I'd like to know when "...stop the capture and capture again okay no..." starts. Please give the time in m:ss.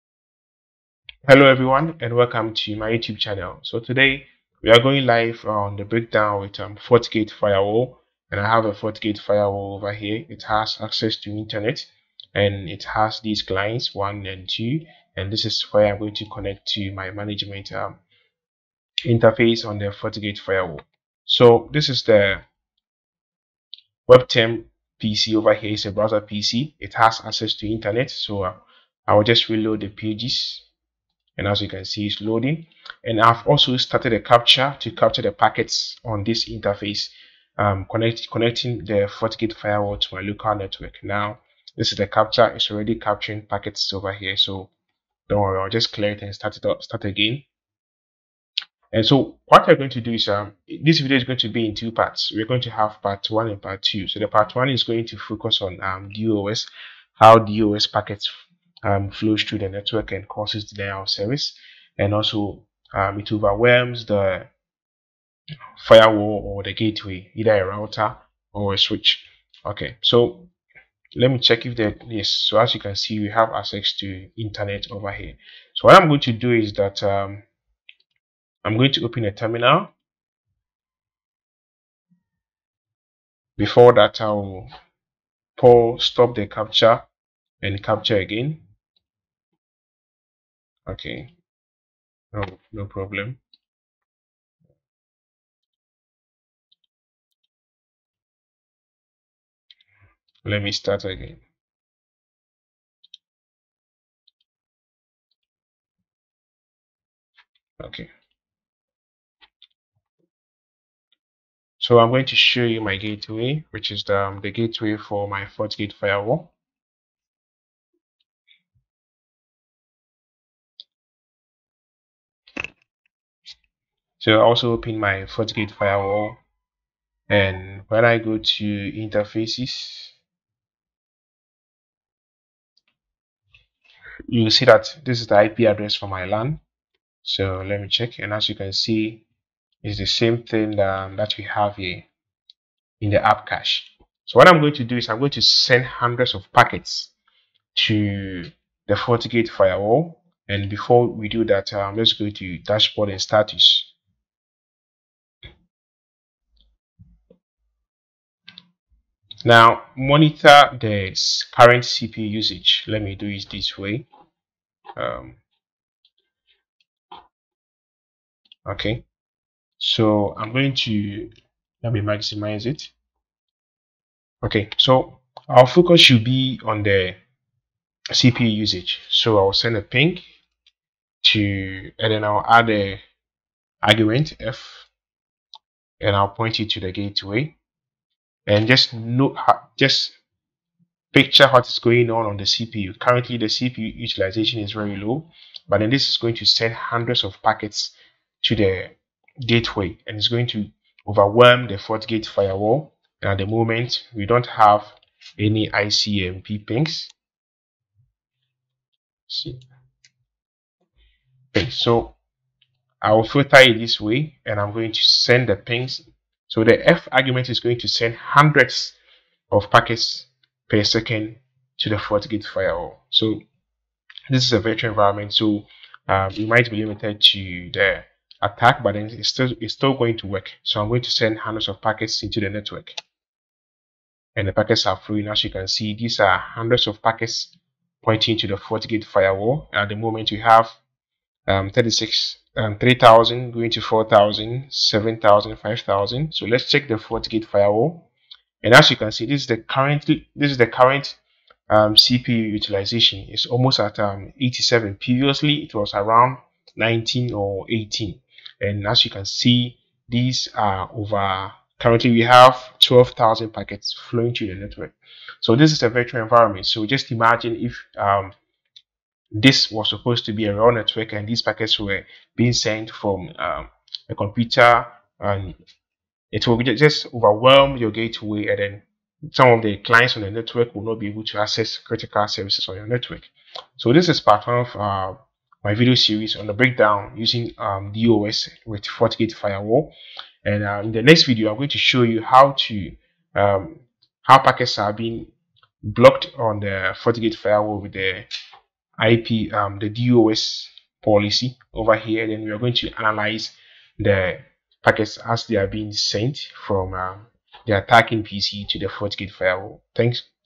1:26.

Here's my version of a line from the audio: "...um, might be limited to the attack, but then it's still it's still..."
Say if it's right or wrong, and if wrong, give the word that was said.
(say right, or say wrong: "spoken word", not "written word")
right.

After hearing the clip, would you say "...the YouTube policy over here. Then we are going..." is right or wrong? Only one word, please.
wrong.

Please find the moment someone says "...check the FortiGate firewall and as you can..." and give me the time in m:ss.
4:06.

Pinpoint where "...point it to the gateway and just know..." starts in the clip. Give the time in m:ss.
3:06.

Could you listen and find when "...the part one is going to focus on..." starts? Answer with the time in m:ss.
0:54.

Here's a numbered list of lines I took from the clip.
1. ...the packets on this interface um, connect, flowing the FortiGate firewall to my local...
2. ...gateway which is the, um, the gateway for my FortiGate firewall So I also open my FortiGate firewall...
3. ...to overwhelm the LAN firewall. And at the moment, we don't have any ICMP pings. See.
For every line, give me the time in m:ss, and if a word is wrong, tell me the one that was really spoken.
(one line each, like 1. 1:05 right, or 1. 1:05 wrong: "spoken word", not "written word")
1. 0:35 wrong: "connecting", not "flowing"
2. 1:52 right
3. 3:20 wrong: "FortiGate", not "LAN".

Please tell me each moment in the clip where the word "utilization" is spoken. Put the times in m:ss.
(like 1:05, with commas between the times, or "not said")
3:13, 4:12.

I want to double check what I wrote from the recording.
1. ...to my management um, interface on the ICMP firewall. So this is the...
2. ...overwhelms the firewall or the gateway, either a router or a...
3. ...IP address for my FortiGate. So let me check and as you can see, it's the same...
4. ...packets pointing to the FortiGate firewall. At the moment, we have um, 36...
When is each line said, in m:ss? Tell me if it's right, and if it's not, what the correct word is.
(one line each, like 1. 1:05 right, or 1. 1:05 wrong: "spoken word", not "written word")
1. 0:16 wrong: "FortiGate", not "ICMP"
2. 1:03 right
3. 2:15 wrong: "LAN", not "FortiGate"
4. 3:57 right.